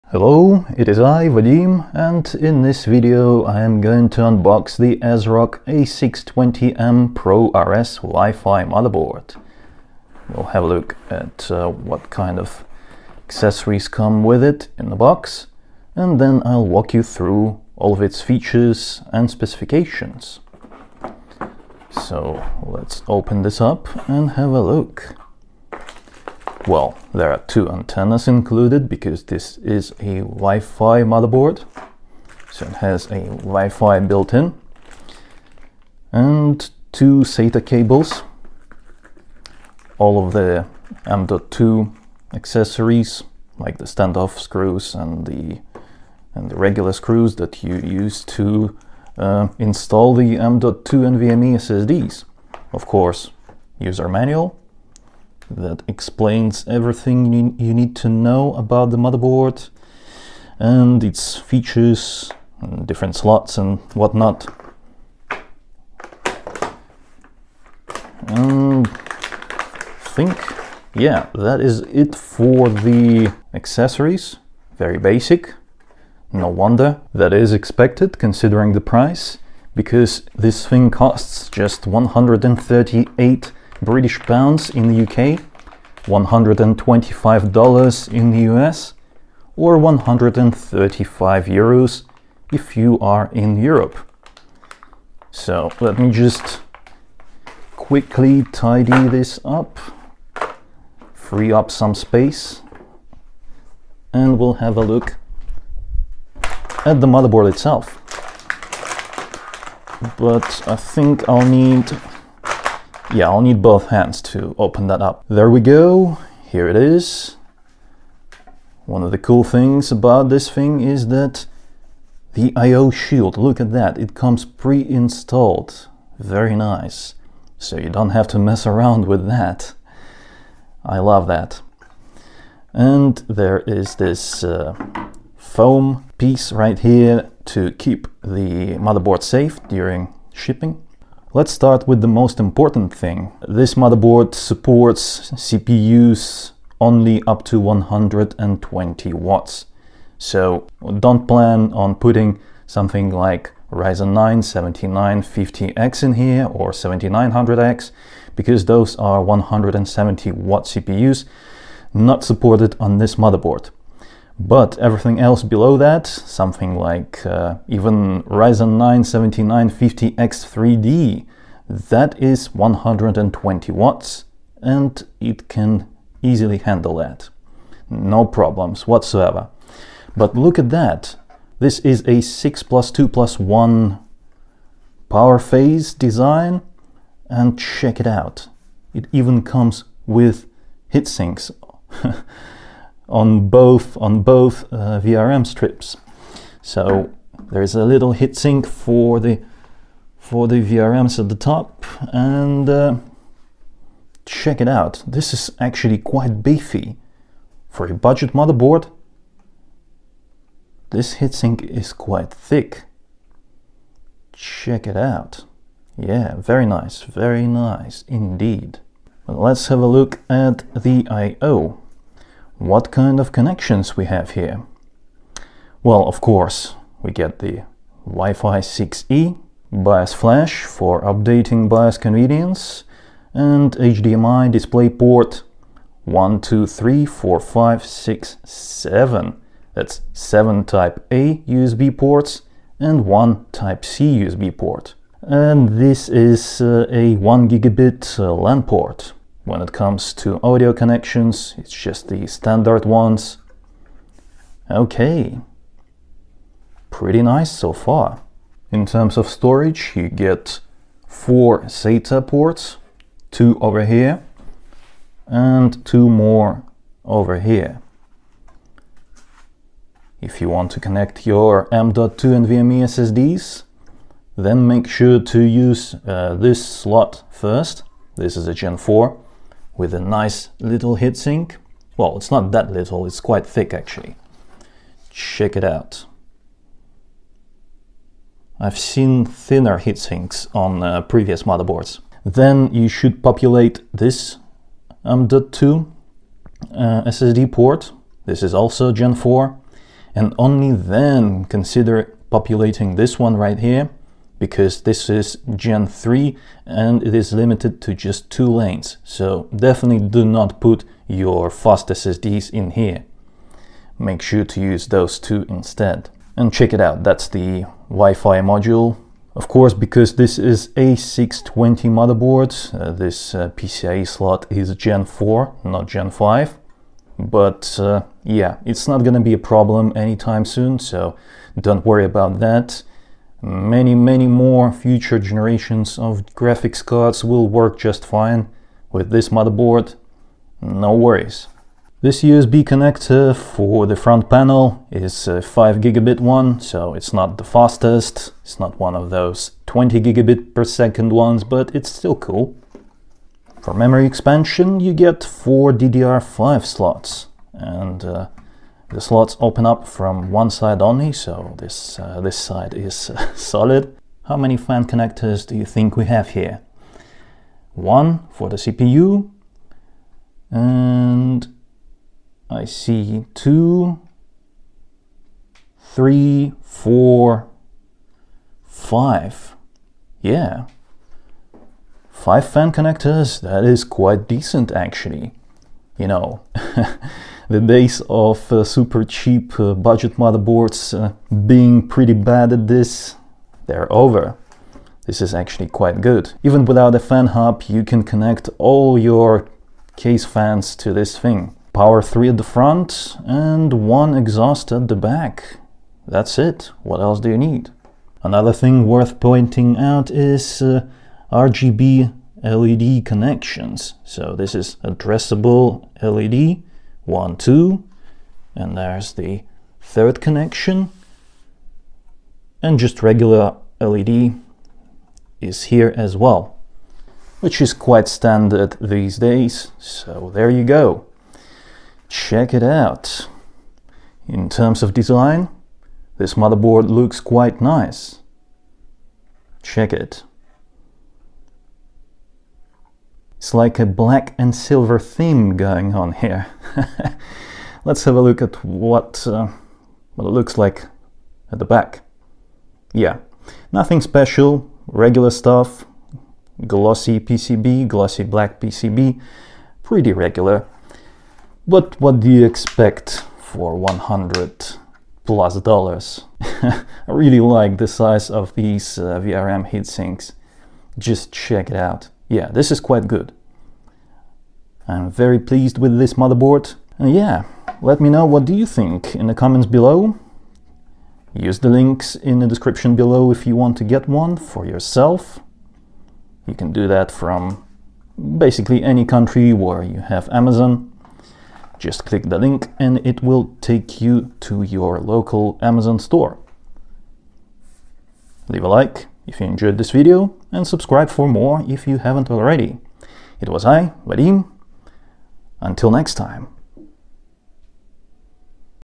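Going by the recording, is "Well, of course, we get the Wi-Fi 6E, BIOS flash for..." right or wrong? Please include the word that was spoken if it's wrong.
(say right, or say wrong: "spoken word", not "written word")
right.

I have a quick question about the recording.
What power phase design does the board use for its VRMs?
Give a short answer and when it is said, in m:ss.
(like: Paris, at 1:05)
6 plus 2 plus 1, at 3:02.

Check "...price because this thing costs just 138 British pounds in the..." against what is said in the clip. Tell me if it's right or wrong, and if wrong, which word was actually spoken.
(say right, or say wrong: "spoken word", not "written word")
right.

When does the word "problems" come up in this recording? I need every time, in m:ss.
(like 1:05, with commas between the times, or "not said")
2:58, 5:29.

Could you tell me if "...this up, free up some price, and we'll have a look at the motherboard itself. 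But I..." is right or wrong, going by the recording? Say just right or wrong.
wrong.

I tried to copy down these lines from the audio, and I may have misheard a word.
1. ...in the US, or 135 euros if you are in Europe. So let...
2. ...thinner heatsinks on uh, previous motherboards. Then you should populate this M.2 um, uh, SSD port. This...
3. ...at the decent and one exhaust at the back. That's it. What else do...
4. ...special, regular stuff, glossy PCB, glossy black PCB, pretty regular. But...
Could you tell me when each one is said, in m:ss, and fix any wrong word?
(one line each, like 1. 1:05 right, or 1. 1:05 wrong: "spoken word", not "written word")
1. 1:28 right
2. 4:49 right
3. 6:42 wrong: "front", not "decent"
4. 7:34 right.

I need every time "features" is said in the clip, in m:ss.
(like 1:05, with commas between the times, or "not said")
0:18, 1:01.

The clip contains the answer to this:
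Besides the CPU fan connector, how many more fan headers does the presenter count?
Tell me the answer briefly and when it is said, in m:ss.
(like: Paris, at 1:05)
5, at 6:22.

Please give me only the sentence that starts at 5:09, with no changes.
So definitely do not put your fast SSDs in here.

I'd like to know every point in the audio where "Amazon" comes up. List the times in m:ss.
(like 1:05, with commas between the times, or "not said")
8:10, 8:15.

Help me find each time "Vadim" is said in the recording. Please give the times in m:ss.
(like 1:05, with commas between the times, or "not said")
0:01, 8:24.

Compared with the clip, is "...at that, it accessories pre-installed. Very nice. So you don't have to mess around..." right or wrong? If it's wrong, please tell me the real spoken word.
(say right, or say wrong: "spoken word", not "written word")
wrong: "comes", not "accessories".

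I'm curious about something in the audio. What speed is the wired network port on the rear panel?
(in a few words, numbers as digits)
1 gigabit.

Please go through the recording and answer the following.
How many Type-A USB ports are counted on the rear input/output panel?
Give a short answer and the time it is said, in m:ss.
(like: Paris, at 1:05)
7, at 4:00.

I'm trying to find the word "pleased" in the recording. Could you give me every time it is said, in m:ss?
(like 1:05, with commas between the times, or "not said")
7:55.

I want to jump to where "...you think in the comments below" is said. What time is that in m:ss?
7:58.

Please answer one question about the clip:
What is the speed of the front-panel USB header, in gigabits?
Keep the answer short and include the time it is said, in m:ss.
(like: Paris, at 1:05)
5 gigabit, at 5:45.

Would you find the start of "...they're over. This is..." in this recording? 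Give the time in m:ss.
6:33.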